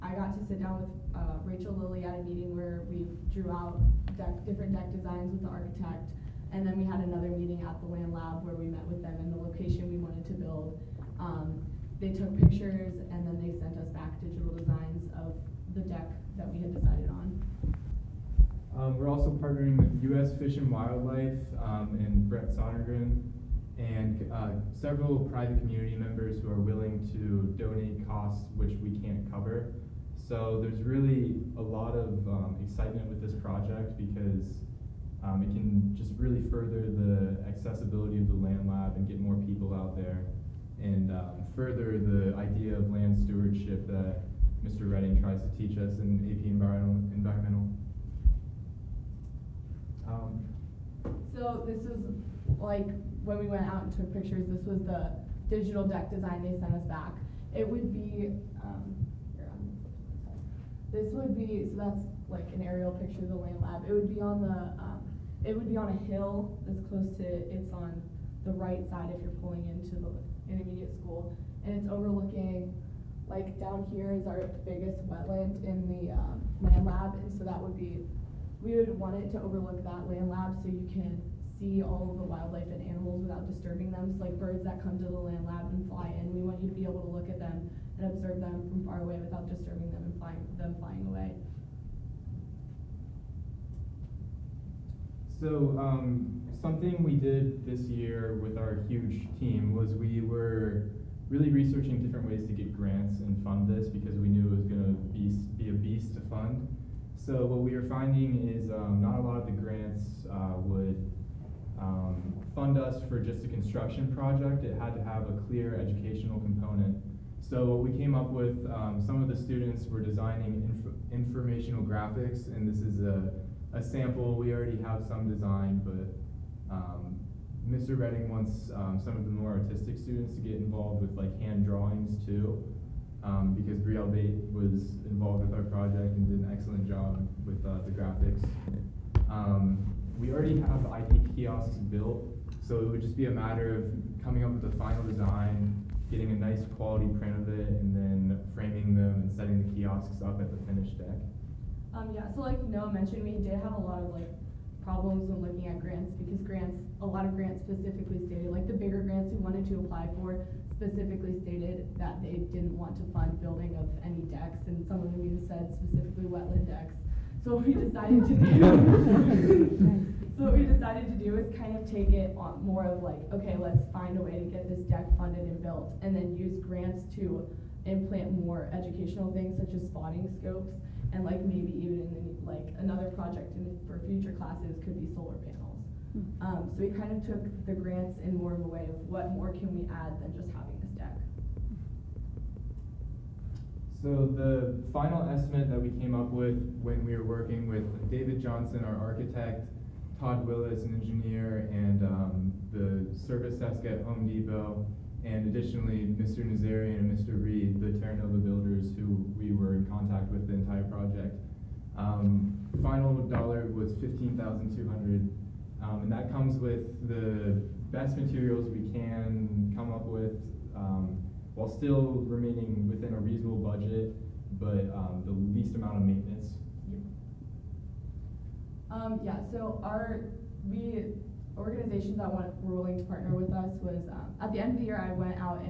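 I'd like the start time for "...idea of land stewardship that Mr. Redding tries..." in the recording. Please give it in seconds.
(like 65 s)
42 s.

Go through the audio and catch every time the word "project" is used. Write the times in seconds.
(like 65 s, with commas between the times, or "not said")
33 s, 114 s, 135 s, 183 s, 210 s.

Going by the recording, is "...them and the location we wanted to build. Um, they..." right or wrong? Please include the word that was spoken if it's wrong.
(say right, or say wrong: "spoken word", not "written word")
right.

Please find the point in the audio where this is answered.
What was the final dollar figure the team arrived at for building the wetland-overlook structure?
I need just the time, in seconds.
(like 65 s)
213 s.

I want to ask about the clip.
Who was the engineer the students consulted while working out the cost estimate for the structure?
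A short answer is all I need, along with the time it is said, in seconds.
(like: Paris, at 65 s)
Todd Willis, at 200 s.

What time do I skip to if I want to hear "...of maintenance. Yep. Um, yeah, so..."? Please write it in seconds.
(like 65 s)
225 s.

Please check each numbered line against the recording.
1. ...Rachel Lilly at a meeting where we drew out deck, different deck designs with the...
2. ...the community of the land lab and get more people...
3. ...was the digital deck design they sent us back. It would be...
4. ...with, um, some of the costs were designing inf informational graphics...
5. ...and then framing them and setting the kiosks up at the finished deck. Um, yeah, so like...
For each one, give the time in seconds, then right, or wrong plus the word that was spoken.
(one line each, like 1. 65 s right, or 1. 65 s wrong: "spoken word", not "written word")
1. 1 s right
2. 36 s wrong: "accessibility", not "community"
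3. 54 s right
4. 118 s wrong: "students", not "costs"
5. 147 s right.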